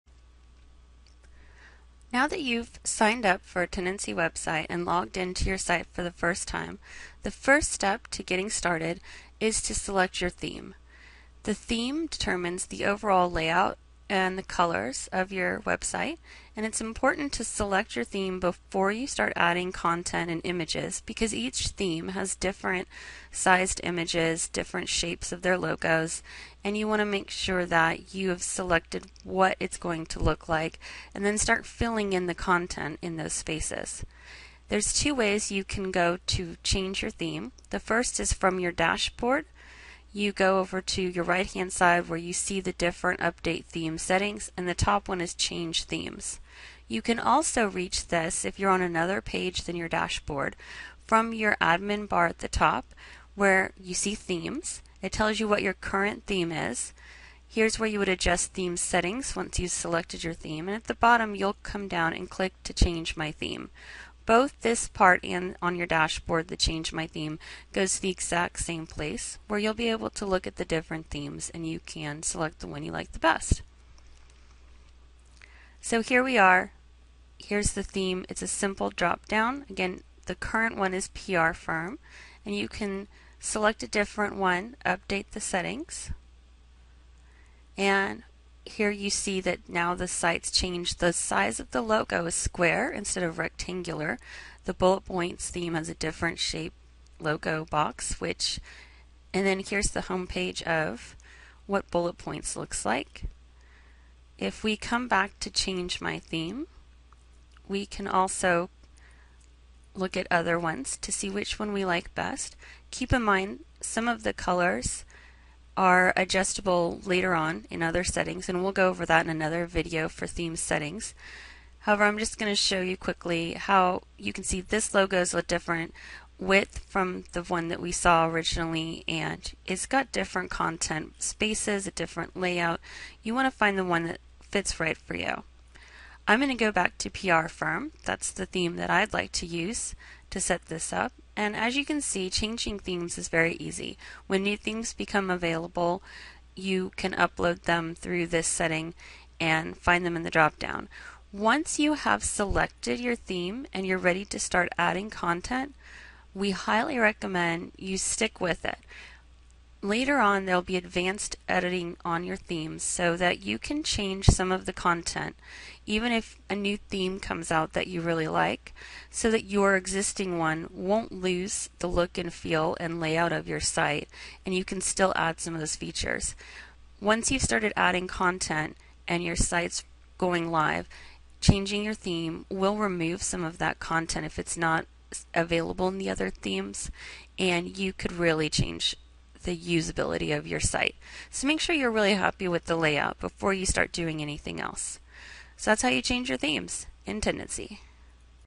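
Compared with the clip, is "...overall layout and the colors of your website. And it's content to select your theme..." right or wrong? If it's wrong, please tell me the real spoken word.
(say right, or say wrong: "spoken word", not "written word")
wrong: "important", not "content".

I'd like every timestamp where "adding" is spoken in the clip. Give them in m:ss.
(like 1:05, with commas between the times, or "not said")
0:19, 2:34, 2:57.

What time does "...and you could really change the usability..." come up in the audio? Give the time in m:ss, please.
3:07.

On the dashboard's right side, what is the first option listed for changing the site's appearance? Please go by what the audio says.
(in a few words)
Change themes.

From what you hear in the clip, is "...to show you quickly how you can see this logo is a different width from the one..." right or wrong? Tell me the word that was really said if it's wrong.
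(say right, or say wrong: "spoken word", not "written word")
right.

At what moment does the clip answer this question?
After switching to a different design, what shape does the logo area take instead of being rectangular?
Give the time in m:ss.
1:32.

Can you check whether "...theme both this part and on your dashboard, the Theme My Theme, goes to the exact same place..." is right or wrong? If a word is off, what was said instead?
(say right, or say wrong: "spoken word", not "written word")
wrong: "Change", not "Theme".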